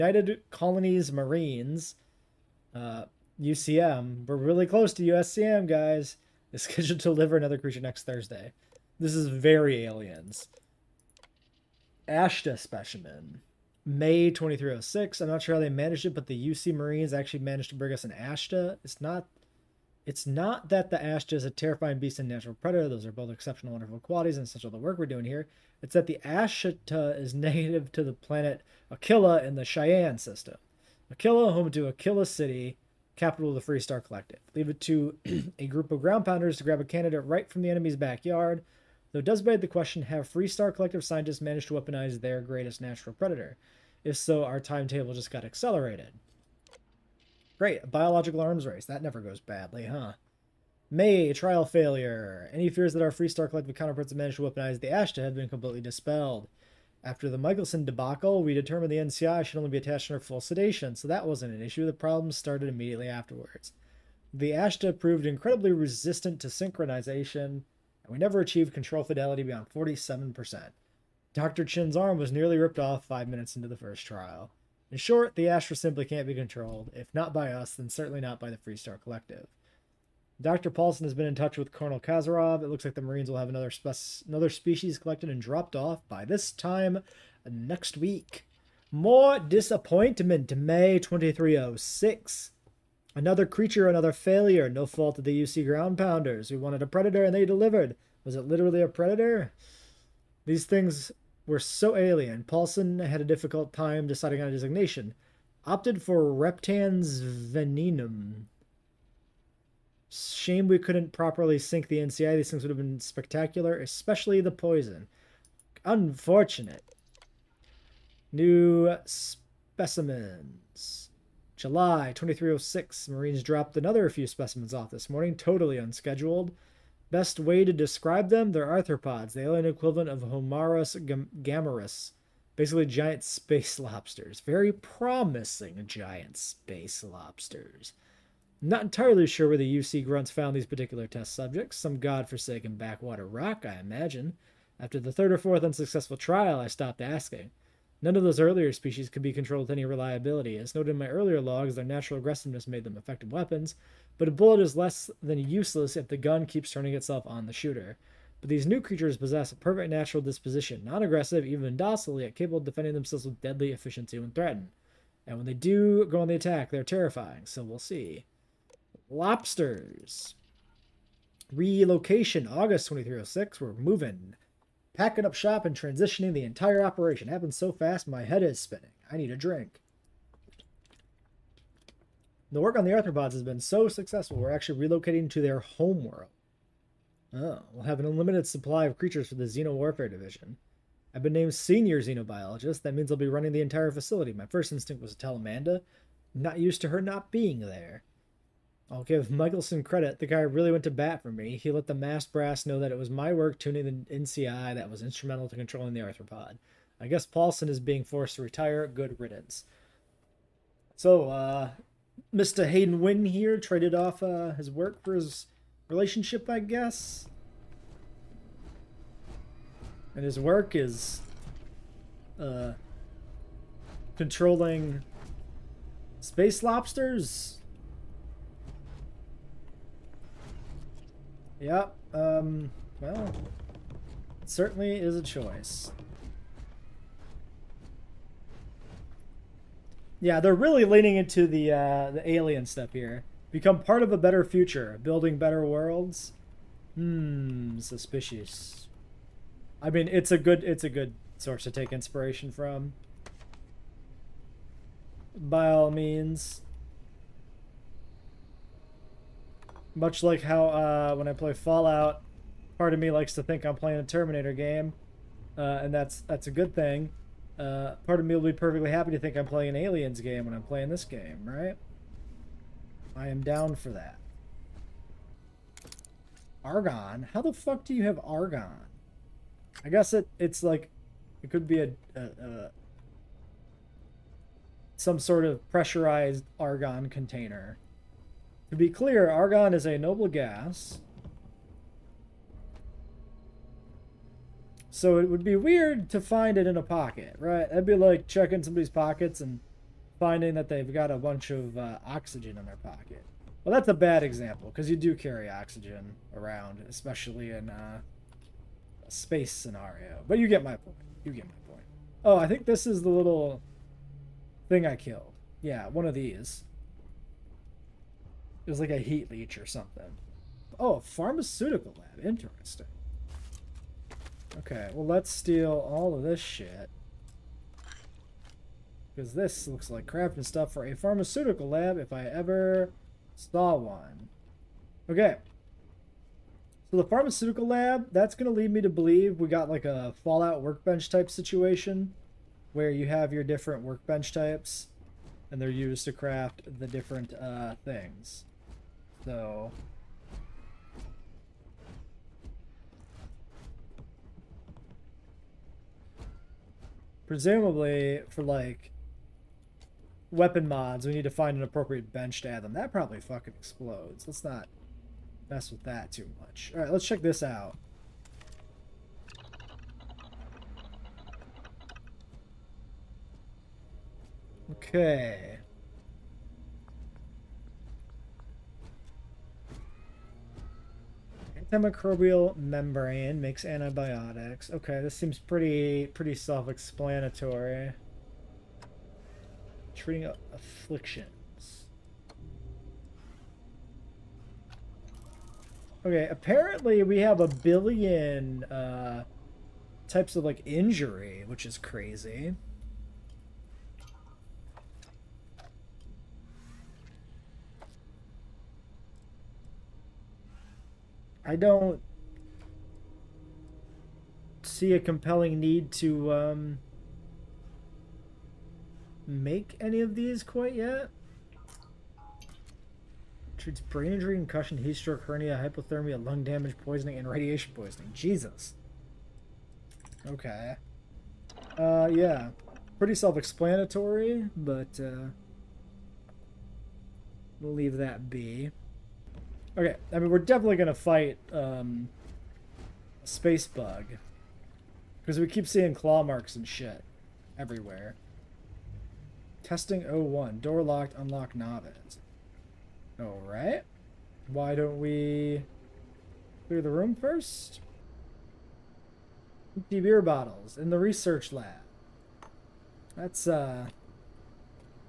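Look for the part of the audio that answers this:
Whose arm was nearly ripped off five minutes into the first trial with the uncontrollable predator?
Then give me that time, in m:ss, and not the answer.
1:11.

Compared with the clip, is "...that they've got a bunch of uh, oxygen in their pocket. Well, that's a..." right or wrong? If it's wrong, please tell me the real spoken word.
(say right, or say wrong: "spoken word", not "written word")
right.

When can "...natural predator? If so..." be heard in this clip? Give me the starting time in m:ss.
0:42.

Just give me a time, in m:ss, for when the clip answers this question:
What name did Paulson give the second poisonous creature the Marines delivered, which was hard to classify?
1:46.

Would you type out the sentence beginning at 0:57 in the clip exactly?
After the Michelson debacle, we determined the NCI should only be attached under full sedation, so that wasn't an issue.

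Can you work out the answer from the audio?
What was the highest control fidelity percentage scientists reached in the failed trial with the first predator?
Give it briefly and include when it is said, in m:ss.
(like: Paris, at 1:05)
47%, at 1:09.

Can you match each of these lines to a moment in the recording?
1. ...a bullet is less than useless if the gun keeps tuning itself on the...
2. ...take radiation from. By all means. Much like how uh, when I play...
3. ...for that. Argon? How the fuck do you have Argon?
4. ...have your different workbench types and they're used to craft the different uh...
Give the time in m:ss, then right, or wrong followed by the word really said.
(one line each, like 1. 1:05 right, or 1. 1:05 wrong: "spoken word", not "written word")
1. 2:34 wrong: "turning", not "tuning"
2. 4:11 wrong: "inspiration", not "radiation"
3. 4:33 right
4. 5:43 right.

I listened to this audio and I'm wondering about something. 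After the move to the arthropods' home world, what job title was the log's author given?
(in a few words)
senior xenobiologist.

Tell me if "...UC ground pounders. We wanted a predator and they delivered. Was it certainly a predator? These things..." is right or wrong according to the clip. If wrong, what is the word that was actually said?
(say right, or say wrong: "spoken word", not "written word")
wrong: "literally", not "certainly".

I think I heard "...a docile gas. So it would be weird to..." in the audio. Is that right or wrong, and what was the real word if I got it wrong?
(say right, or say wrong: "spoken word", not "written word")
wrong: "noble", not "docile".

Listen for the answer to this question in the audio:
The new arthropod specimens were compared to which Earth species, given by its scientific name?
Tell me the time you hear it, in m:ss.
2:10.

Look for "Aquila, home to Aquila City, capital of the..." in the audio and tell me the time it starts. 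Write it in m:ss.
0:31.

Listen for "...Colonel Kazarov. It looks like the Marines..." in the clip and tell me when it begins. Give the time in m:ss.
1:21.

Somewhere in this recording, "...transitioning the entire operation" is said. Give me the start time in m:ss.
2:55.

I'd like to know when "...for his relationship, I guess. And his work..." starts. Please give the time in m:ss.
3:35.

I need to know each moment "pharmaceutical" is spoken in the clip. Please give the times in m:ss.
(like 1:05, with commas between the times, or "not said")
5:20, 5:30, 5:37.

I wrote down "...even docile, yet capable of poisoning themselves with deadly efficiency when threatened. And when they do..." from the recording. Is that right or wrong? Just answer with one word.
wrong.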